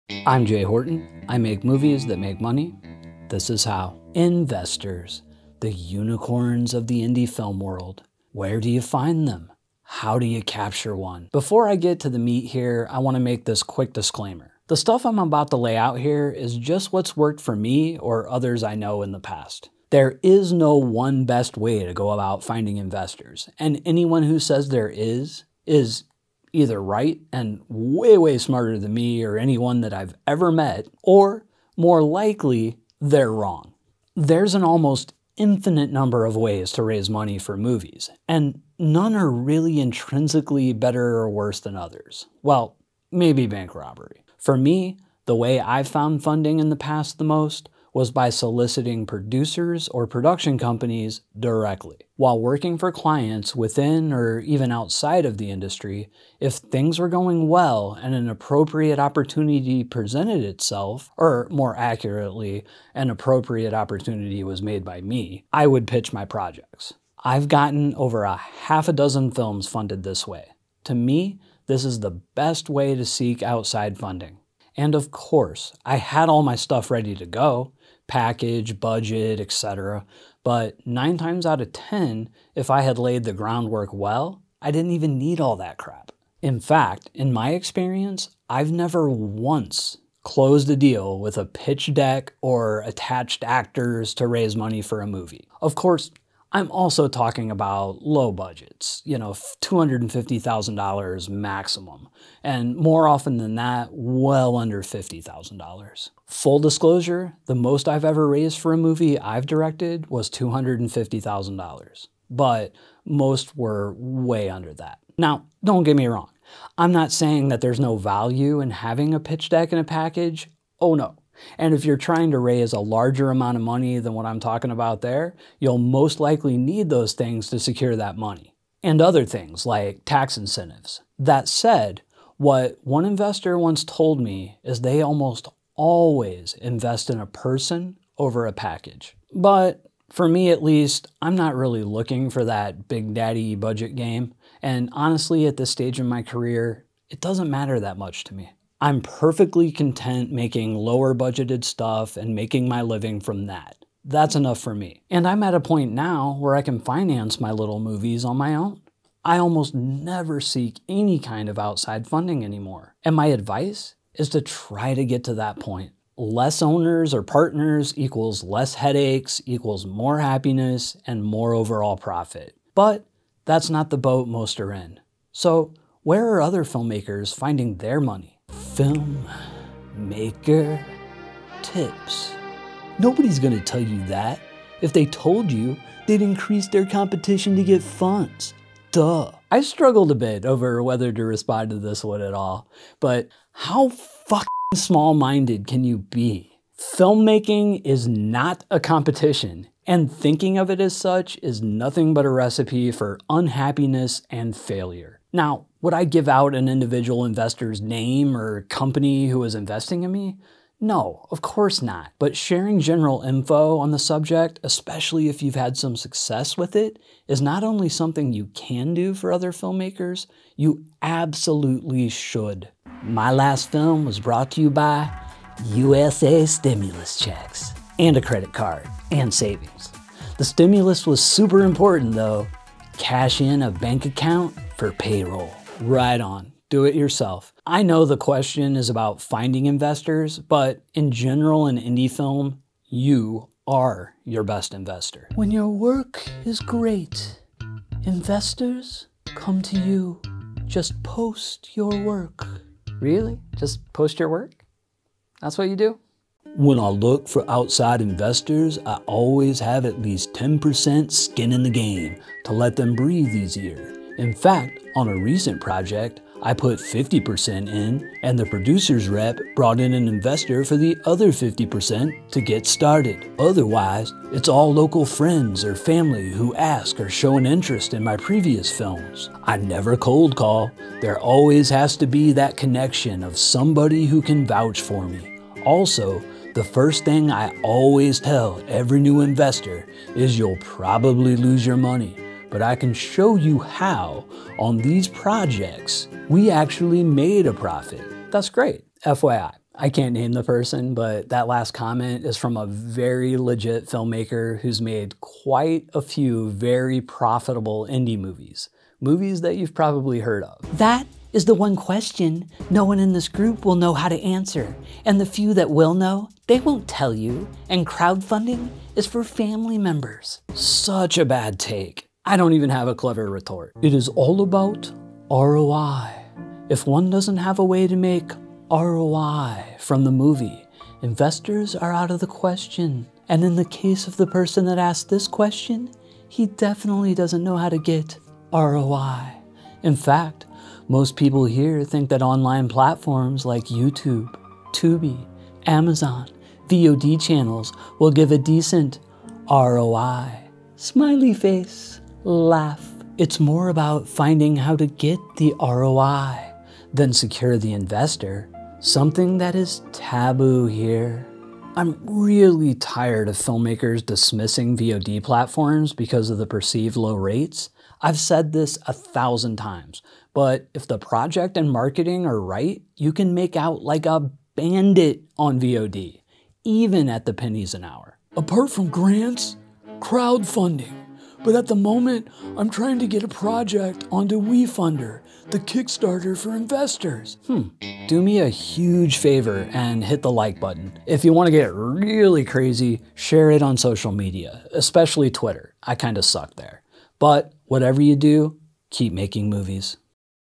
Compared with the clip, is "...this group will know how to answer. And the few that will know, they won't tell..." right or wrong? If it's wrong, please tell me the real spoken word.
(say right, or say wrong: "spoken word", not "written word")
right.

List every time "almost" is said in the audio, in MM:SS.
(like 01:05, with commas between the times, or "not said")
00:34, 02:15, 02:39.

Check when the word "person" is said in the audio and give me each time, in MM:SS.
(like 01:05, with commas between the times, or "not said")
02:17, 05:00, 05:34.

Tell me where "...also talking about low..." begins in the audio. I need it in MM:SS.
01:36.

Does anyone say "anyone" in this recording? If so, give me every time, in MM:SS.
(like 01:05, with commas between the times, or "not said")
00:23, 00:29.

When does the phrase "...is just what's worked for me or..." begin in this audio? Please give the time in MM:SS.
00:16.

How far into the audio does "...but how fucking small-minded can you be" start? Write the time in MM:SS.
03:12.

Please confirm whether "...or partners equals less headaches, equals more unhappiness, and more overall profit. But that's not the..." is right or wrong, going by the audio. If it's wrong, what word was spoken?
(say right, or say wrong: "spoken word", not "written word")
wrong: "happiness", not "unhappiness".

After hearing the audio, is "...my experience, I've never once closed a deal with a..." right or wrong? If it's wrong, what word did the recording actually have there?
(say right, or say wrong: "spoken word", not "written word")
right.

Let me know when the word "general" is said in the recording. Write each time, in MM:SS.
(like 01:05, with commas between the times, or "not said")
03:32, 04:01.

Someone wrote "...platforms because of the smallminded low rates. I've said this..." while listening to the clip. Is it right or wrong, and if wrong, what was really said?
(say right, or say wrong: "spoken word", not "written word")
wrong: "perceived", not "smallminded".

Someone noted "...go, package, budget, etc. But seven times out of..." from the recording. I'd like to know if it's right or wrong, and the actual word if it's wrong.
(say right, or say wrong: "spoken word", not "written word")
wrong: "nine", not "seven".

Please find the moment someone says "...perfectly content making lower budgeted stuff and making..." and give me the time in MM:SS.
02:29.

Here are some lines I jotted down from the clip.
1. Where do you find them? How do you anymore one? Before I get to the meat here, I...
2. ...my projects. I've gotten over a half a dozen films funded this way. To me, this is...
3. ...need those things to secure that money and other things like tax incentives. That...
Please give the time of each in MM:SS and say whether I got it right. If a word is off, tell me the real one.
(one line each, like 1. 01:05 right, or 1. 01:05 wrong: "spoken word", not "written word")
1. 00:08 wrong: "capture", not "anymore"
2. 01:06 right
3. 02:06 right.